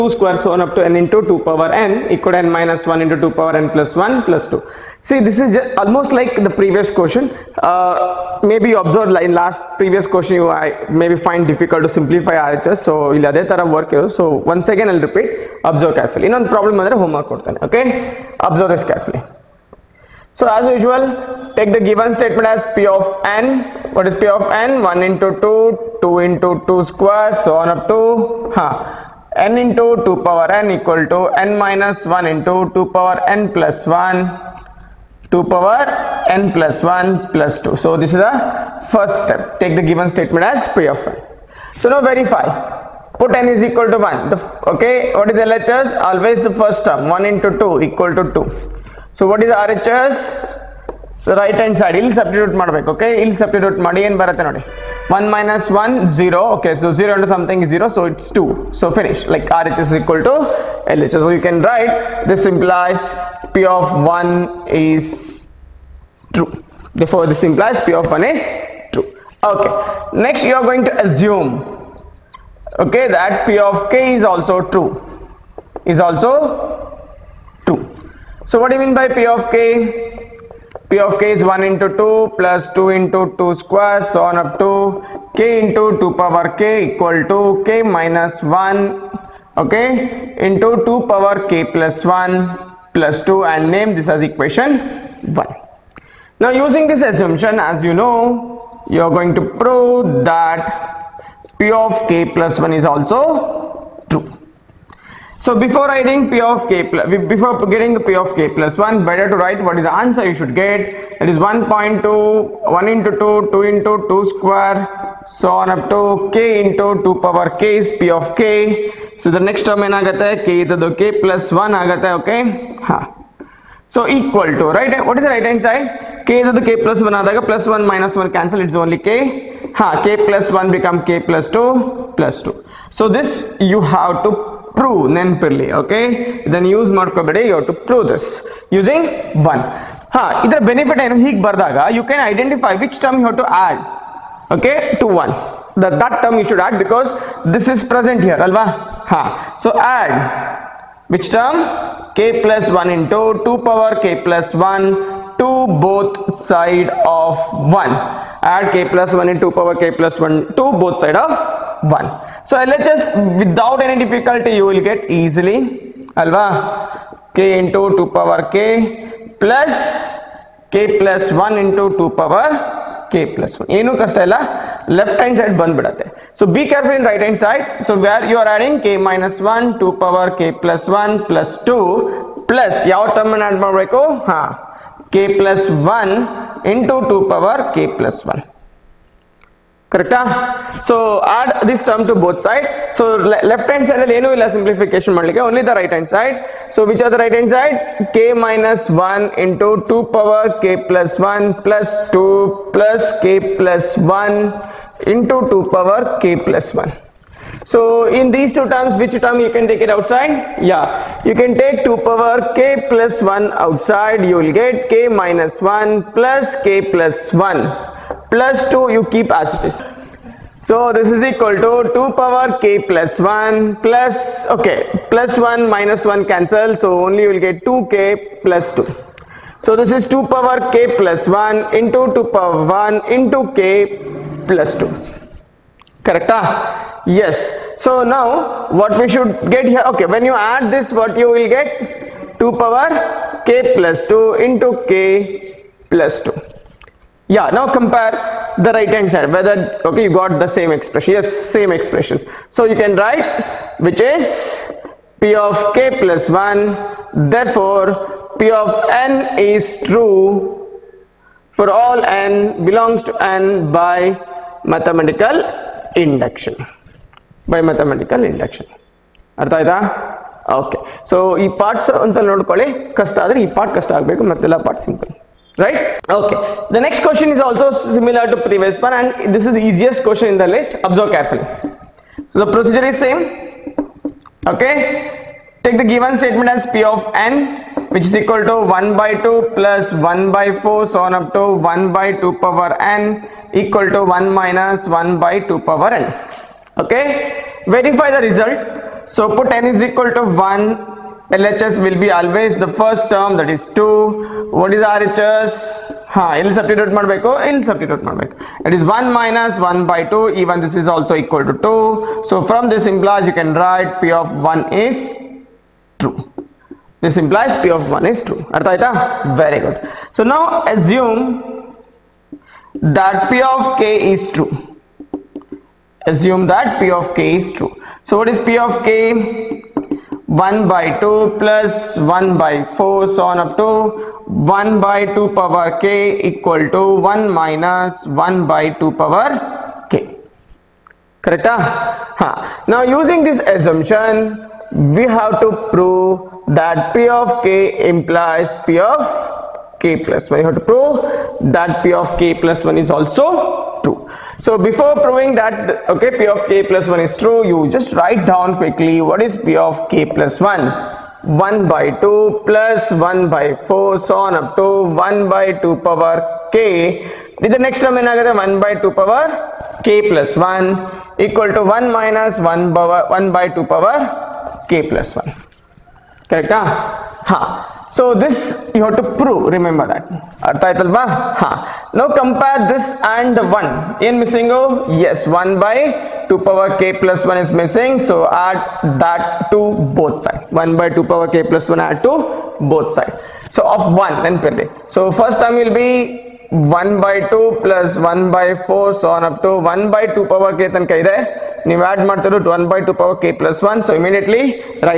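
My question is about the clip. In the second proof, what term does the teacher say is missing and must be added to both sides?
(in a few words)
1 by 2 power k plus 1.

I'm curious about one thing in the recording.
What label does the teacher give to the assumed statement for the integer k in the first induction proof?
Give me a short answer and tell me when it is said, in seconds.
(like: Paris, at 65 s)
equation 1, at 93 s.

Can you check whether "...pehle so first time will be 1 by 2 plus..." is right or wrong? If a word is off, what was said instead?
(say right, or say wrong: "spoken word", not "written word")
right.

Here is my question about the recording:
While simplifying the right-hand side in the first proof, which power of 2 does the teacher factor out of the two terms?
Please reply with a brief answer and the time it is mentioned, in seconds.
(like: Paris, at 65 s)
2 power k plus 1, at 211 s.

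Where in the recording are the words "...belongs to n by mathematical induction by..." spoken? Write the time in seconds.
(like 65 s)
262 s.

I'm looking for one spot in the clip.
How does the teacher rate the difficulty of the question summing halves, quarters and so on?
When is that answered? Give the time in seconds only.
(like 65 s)
279 s.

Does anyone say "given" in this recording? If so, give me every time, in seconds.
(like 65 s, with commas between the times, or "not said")
21 s, 39 s, 285 s.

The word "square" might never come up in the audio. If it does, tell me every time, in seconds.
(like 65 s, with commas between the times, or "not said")
0 s, 26 s, 83 s, 114 s.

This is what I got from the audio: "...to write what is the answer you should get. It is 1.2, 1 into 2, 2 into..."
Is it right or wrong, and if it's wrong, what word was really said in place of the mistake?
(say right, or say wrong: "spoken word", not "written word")
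right.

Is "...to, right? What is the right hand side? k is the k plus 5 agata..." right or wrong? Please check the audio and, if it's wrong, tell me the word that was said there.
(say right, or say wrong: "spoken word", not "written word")
wrong: "1", not "5".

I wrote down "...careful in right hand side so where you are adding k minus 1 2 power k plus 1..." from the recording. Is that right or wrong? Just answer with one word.
right.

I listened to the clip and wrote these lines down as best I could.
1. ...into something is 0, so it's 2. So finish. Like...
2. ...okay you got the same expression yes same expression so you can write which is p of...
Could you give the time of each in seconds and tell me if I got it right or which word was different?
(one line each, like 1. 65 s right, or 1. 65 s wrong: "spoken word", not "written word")
1. 57 s right
2. 249 s right.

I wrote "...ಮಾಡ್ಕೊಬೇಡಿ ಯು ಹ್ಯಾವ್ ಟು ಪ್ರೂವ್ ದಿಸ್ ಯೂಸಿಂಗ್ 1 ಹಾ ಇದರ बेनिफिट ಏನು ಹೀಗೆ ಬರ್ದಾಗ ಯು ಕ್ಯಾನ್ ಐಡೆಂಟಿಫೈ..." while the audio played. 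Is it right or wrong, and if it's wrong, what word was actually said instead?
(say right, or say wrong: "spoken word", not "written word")
right.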